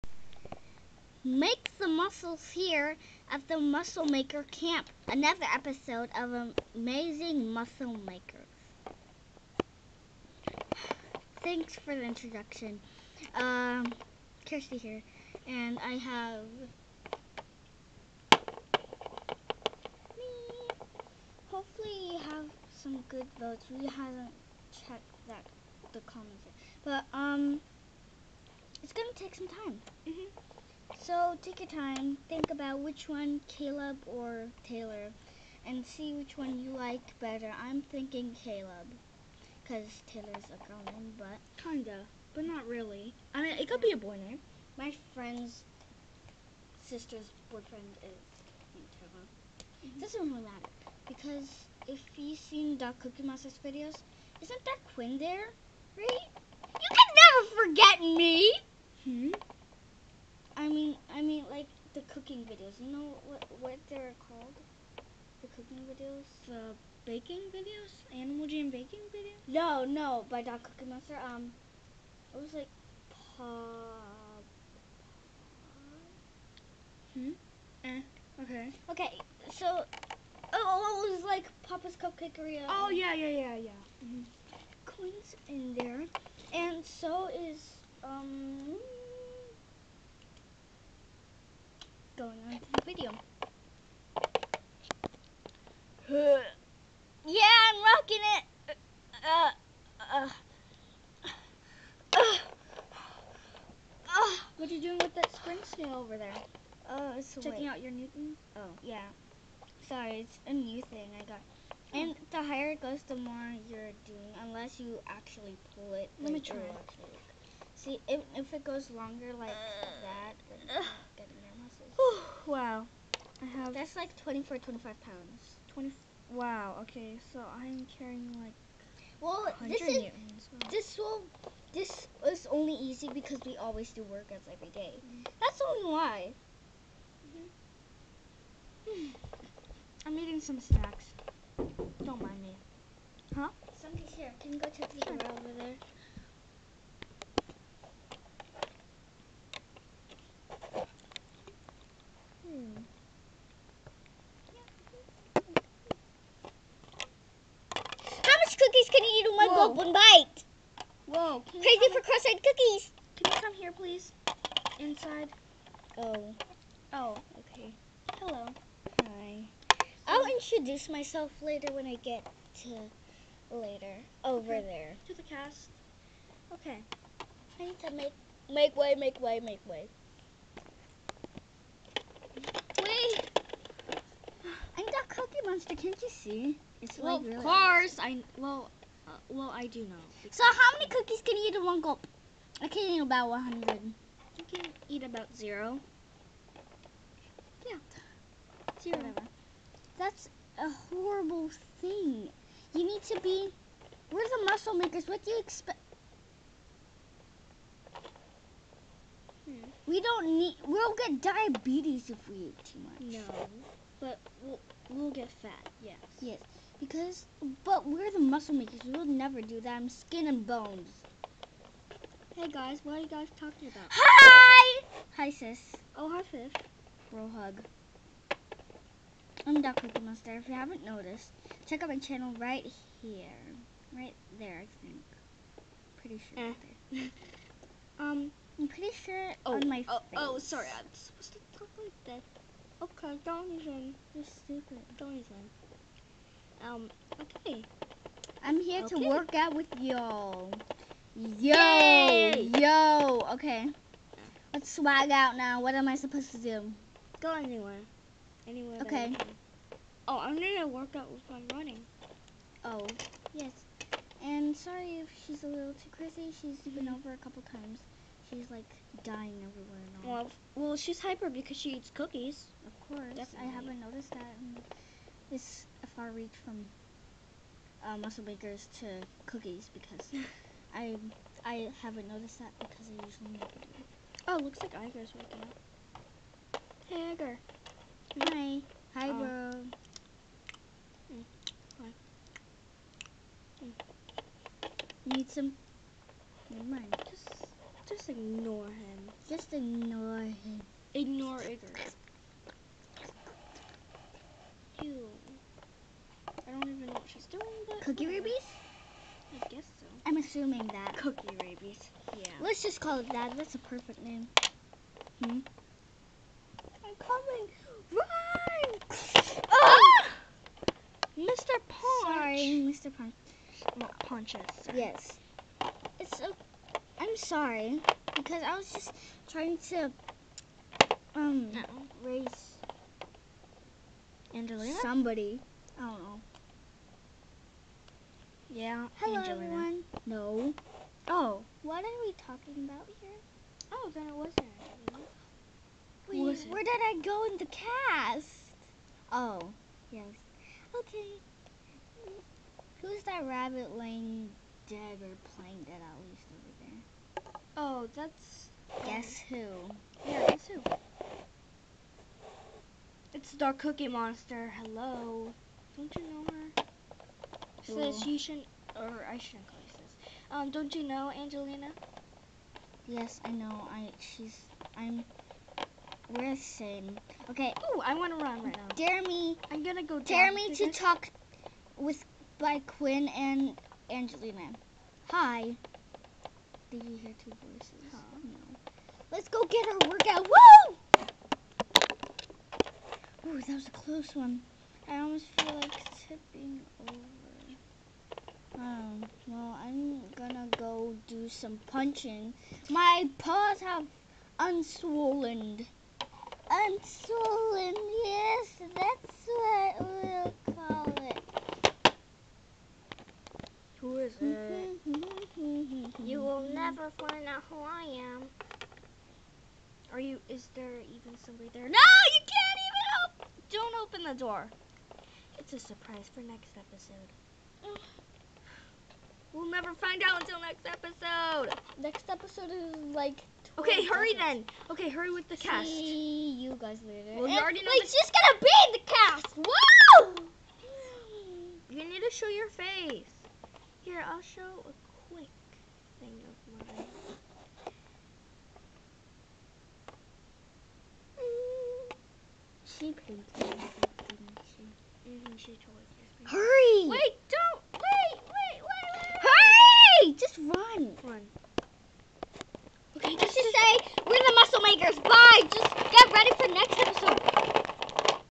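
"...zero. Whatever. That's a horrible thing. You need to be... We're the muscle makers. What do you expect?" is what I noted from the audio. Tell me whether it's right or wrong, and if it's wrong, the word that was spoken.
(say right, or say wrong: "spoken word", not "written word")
right.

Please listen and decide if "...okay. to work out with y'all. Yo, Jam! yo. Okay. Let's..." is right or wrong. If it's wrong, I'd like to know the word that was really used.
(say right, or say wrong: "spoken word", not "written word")
wrong: "Yay", not "Jam".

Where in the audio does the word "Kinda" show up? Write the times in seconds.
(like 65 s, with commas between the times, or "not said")
41 s.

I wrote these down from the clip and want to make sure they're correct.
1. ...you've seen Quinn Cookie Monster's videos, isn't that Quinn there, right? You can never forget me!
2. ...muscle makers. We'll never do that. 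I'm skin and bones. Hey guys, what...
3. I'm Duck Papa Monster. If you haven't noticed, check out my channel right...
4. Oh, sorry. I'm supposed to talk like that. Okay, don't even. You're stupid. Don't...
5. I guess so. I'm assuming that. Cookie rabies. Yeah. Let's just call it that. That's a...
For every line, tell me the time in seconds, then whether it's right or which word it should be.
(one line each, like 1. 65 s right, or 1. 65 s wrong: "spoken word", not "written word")
1. 52 s wrong: "Doc", not "Quinn"
2. 218 s right
3. 229 s wrong: "Cookie", not "Papa"
4. 240 s right
5. 309 s right.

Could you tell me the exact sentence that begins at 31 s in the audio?
So take your time, think about which one, Caleb or Taylor, and see which one you like better.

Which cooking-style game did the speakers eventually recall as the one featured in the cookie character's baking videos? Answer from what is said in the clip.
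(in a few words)
Papa's Cupcakeria.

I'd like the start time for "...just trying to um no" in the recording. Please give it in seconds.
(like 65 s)
328 s.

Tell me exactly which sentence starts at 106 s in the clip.
Oh, it's Checking out your new thing?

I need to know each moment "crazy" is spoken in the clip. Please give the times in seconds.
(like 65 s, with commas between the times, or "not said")
161 s, 265 s.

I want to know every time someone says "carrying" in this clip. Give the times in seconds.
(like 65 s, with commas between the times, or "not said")
127 s.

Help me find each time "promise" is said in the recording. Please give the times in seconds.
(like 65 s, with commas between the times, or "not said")
not said.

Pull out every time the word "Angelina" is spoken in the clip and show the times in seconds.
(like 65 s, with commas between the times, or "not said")
334 s, 371 s, 383 s.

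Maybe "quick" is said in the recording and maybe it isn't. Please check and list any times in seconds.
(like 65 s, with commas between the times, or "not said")
445 s.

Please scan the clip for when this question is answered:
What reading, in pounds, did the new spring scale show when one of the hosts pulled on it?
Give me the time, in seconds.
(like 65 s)
124 s.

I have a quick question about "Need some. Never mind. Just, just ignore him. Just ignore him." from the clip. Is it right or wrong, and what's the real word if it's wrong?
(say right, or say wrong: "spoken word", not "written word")
right.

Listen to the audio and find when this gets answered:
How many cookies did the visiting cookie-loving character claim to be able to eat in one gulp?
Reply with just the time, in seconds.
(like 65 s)
193 s.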